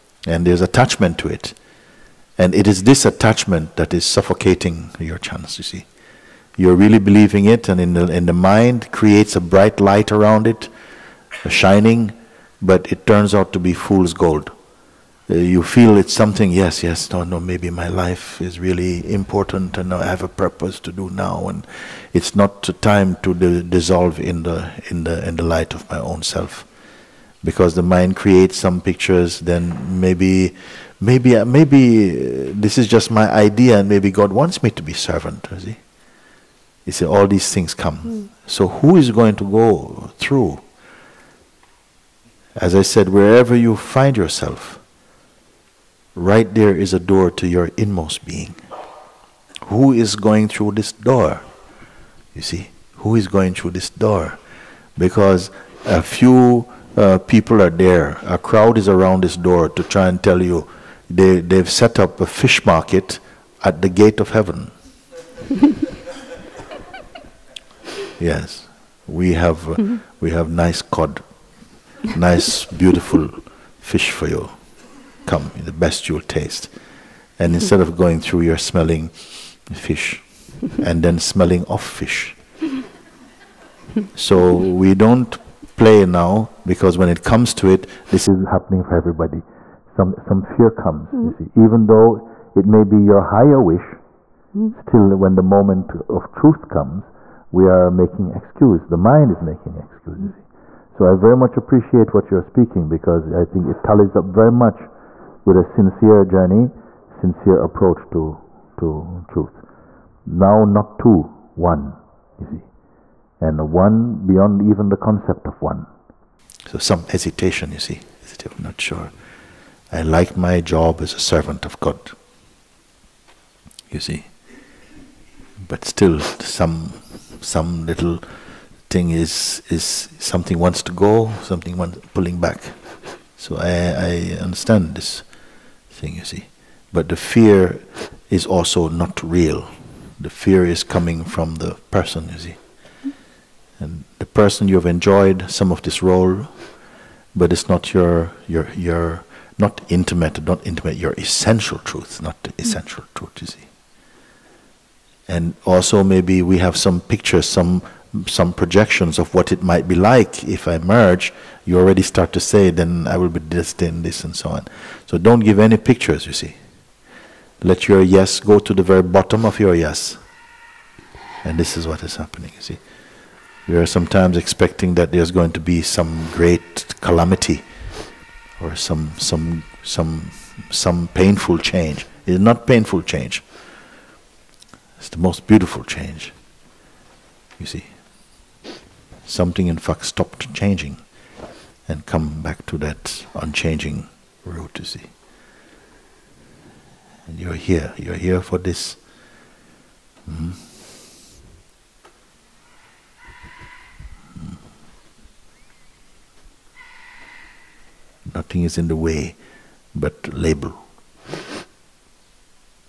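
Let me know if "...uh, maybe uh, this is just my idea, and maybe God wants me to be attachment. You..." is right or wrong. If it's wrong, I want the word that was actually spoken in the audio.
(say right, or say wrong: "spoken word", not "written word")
wrong: "servant", not "attachment".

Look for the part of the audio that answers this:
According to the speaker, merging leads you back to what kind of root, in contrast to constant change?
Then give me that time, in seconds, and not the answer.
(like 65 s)
193 s.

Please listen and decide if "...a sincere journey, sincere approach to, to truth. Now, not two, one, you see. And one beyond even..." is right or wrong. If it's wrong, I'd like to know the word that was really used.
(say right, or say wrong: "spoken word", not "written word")
right.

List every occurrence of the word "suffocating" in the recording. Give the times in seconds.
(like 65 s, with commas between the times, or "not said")
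4 s.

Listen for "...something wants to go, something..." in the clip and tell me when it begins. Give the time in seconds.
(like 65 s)
130 s.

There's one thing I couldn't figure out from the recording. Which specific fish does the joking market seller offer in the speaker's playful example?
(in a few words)
cod.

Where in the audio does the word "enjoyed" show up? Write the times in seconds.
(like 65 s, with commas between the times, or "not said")
144 s.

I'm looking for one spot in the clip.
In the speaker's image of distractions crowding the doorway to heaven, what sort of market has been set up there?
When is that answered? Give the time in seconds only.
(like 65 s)
62 s.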